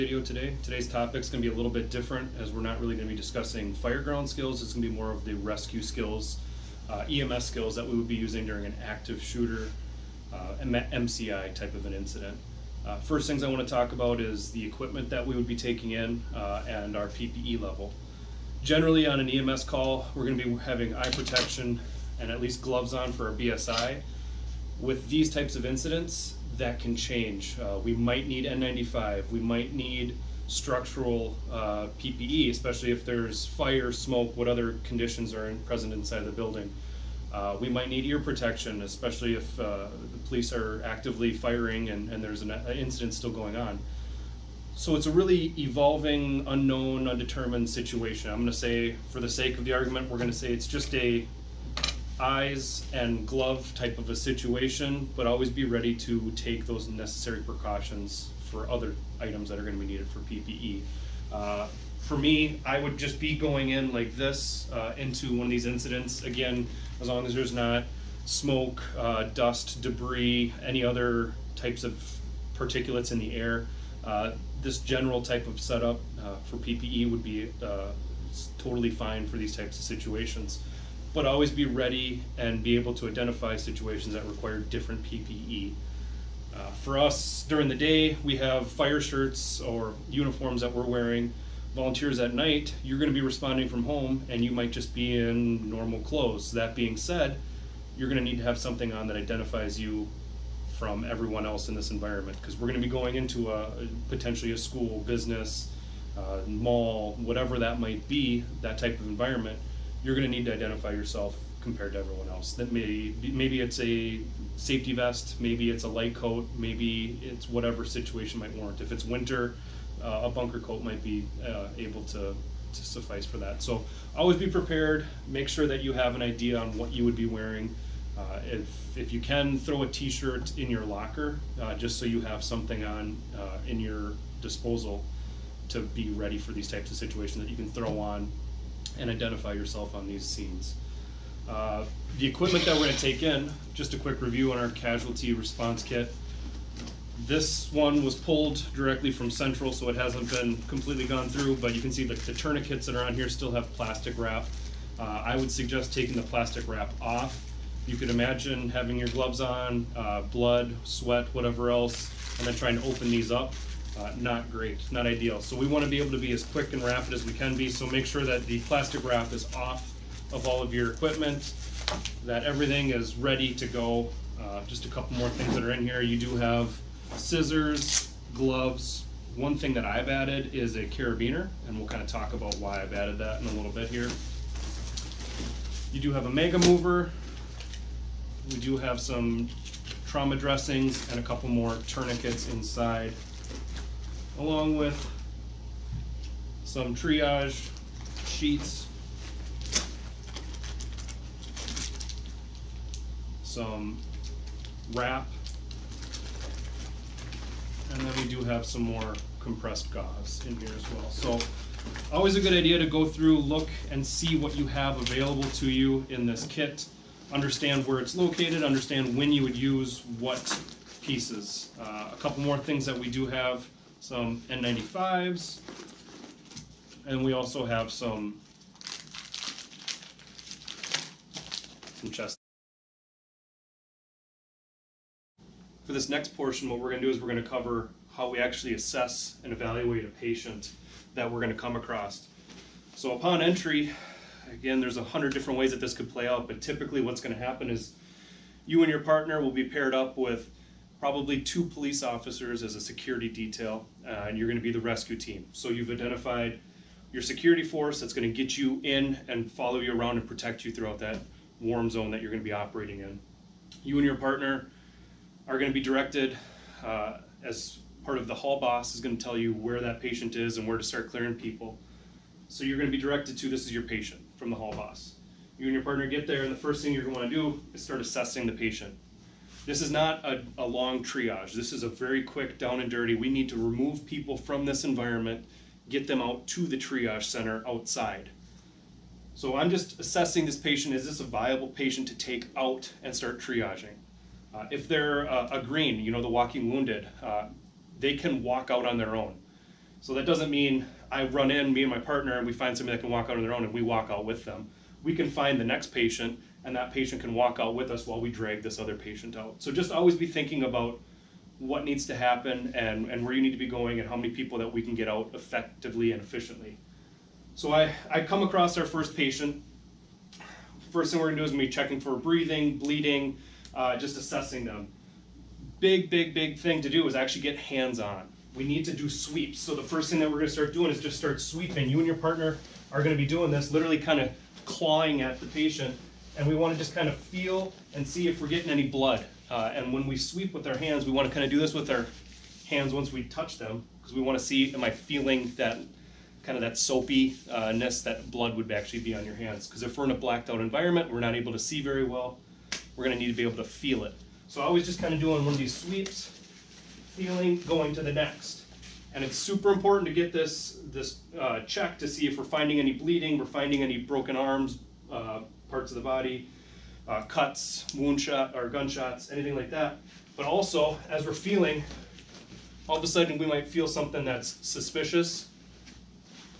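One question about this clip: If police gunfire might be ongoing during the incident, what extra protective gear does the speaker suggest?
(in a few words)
Ear protection.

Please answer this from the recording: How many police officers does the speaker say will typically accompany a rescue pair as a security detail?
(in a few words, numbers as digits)
2.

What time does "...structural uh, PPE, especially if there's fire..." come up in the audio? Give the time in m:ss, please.
0:30.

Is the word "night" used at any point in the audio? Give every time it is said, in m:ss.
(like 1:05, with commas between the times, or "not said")
1:32.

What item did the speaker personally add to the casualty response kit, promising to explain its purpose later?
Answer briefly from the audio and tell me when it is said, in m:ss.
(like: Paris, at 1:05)
A carabiner, at 3:00.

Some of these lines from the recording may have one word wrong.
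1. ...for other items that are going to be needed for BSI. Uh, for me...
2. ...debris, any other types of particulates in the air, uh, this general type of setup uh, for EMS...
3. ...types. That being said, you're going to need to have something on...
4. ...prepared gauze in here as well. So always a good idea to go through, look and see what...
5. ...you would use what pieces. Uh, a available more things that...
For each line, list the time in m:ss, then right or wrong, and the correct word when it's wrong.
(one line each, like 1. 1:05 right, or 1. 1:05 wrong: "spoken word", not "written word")
1. 0:58 wrong: "PPE", not "BSI"
2. 1:09 wrong: "PPE", not "EMS"
3. 1:36 wrong: "clothes", not "types"
4. 3:29 wrong: "compressed", not "prepared"
5. 3:39 wrong: "couple", not "available".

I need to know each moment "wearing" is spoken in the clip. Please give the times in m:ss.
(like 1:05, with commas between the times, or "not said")
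1:30, 2:07.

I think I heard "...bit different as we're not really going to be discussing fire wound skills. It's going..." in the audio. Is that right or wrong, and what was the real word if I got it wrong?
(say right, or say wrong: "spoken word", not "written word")
wrong: "ground", not "wound".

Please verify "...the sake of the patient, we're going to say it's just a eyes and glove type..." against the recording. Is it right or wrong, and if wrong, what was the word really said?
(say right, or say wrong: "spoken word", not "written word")
wrong: "argument", not "patient".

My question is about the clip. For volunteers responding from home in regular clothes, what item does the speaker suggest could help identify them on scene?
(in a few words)
Safety vest.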